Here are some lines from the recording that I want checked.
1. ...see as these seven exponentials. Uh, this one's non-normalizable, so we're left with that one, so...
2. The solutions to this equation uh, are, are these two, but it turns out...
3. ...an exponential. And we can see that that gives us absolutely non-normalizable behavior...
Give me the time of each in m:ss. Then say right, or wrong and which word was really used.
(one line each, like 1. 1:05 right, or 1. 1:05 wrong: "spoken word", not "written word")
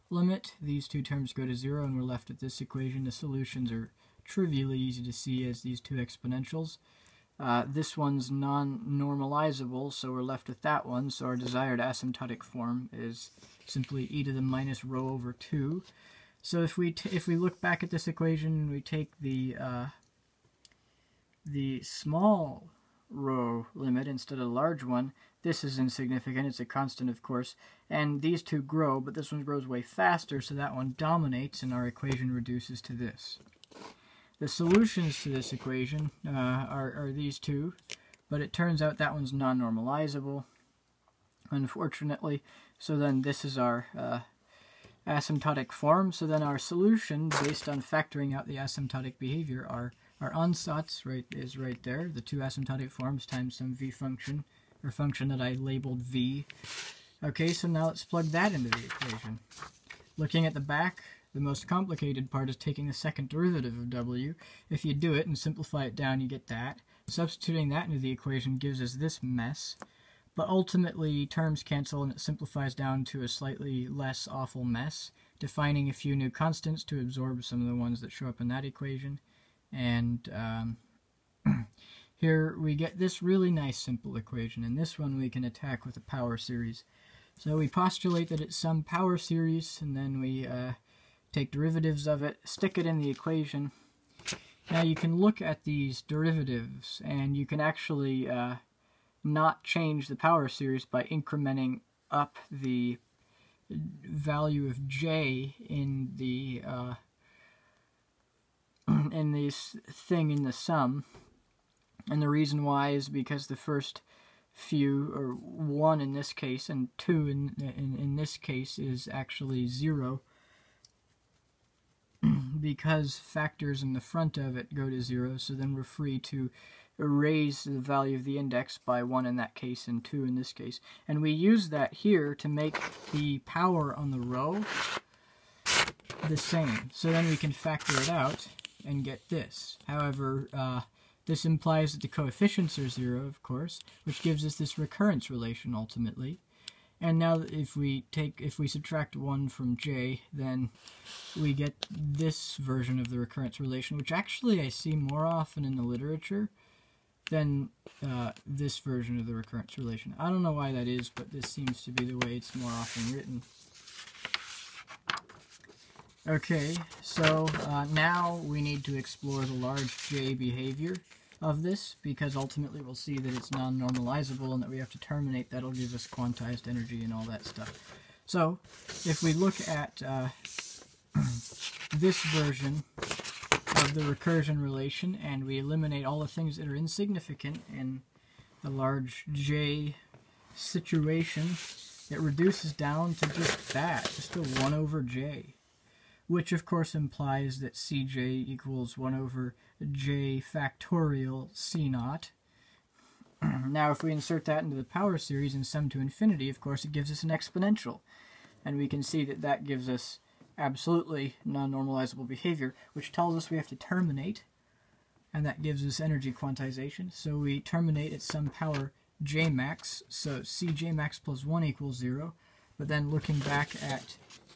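1. 0:05 wrong: "two", not "seven"
2. 0:34 right
3. 3:27 right.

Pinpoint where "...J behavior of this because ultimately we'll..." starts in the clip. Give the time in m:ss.
2:50.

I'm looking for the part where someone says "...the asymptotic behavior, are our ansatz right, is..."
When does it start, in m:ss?
0:48.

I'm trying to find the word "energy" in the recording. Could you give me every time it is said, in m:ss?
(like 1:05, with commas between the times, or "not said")
2:56, 3:36.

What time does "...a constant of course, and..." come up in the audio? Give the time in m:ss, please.
0:26.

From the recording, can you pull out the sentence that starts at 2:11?
And we use that here to make the power on the rho the same.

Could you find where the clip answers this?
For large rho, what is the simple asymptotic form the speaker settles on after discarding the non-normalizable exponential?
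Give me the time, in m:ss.
0:14.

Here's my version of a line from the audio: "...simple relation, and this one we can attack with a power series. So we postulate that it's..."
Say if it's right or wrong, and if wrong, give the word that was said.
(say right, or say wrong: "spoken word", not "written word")
wrong: "equation", not "relation".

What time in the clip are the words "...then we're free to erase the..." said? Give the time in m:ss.
2:05.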